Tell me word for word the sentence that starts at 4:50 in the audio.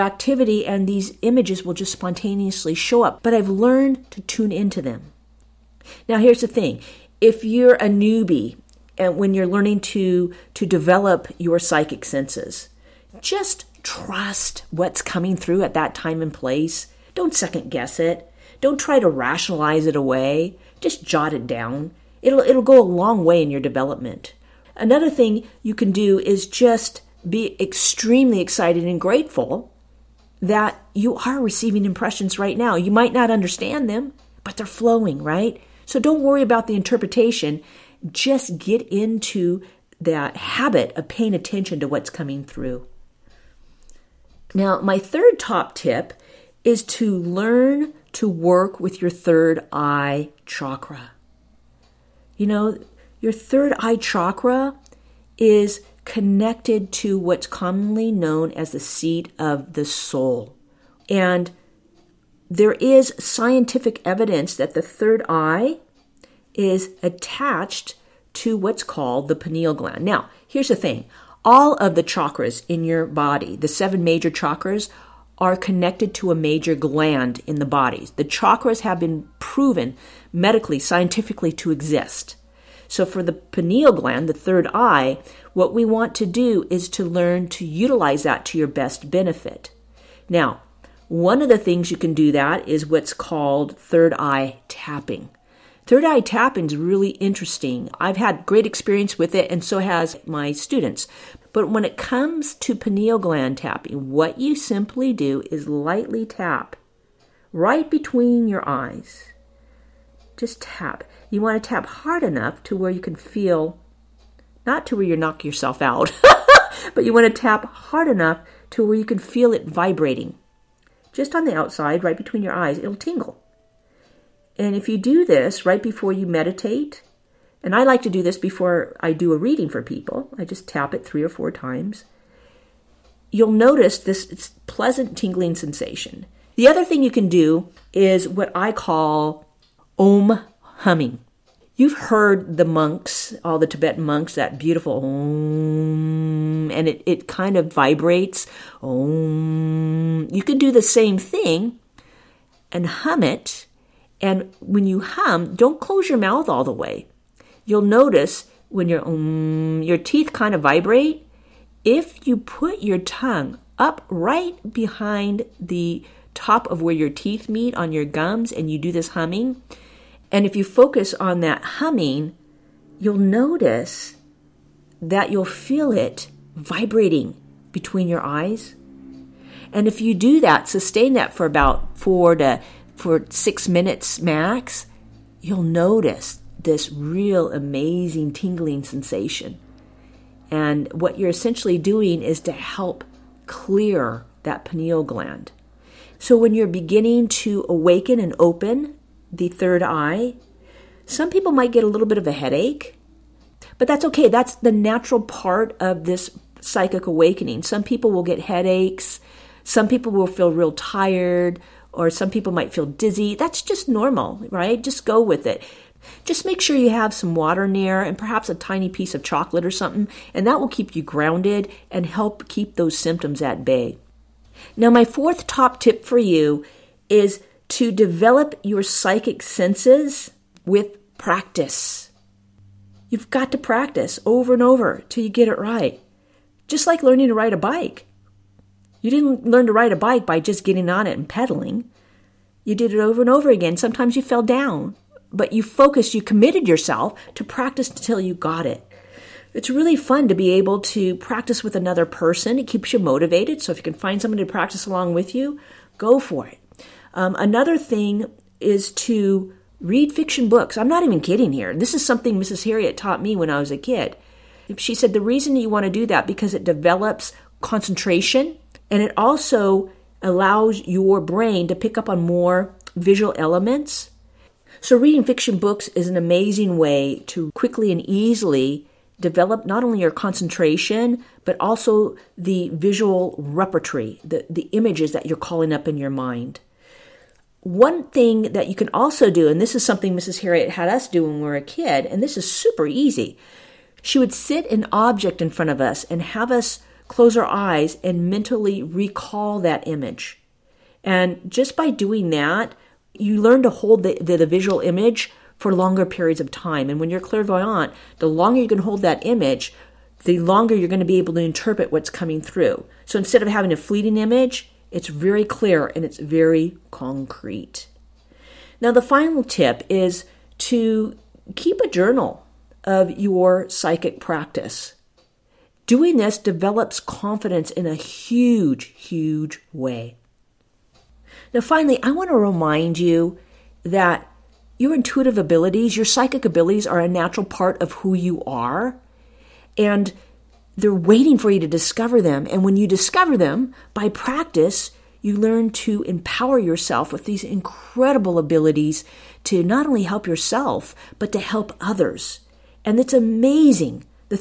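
Harriet had us do when we were a kid, and this is super easy.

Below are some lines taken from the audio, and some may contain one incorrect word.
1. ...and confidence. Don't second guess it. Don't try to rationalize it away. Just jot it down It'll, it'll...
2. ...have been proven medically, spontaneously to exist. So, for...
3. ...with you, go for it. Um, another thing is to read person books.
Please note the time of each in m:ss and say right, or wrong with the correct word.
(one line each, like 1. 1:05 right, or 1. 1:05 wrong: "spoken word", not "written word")
1. 0:16 wrong: "place", not "confidence"
2. 1:18 wrong: "scientifically", not "spontaneously"
3. 4:15 wrong: "fiction", not "person".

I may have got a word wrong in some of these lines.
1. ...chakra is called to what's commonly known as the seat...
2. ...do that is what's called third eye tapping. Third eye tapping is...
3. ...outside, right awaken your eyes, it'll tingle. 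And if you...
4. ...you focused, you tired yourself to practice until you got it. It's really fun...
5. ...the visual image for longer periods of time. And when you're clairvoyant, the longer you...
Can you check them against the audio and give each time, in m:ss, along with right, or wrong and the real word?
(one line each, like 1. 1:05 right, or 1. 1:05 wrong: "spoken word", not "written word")
1. 0:53 wrong: "connected", not "called"
2. 1:32 right
3. 2:01 wrong: "between", not "awaken"
4. 4:05 wrong: "committed", not "tired"
5. 5:04 right.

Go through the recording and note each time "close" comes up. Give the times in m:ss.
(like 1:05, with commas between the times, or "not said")
2:35, 4:57.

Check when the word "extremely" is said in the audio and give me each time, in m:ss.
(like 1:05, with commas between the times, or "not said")
0:27.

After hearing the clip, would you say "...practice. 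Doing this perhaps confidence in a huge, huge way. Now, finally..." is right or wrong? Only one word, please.
wrong.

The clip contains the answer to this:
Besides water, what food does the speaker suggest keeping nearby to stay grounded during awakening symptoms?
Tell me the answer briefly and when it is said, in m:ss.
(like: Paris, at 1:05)
Chocolate, at 3:39.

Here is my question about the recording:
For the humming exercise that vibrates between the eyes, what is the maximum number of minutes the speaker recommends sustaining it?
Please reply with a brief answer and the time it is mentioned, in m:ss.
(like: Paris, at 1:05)
6, at 3:03.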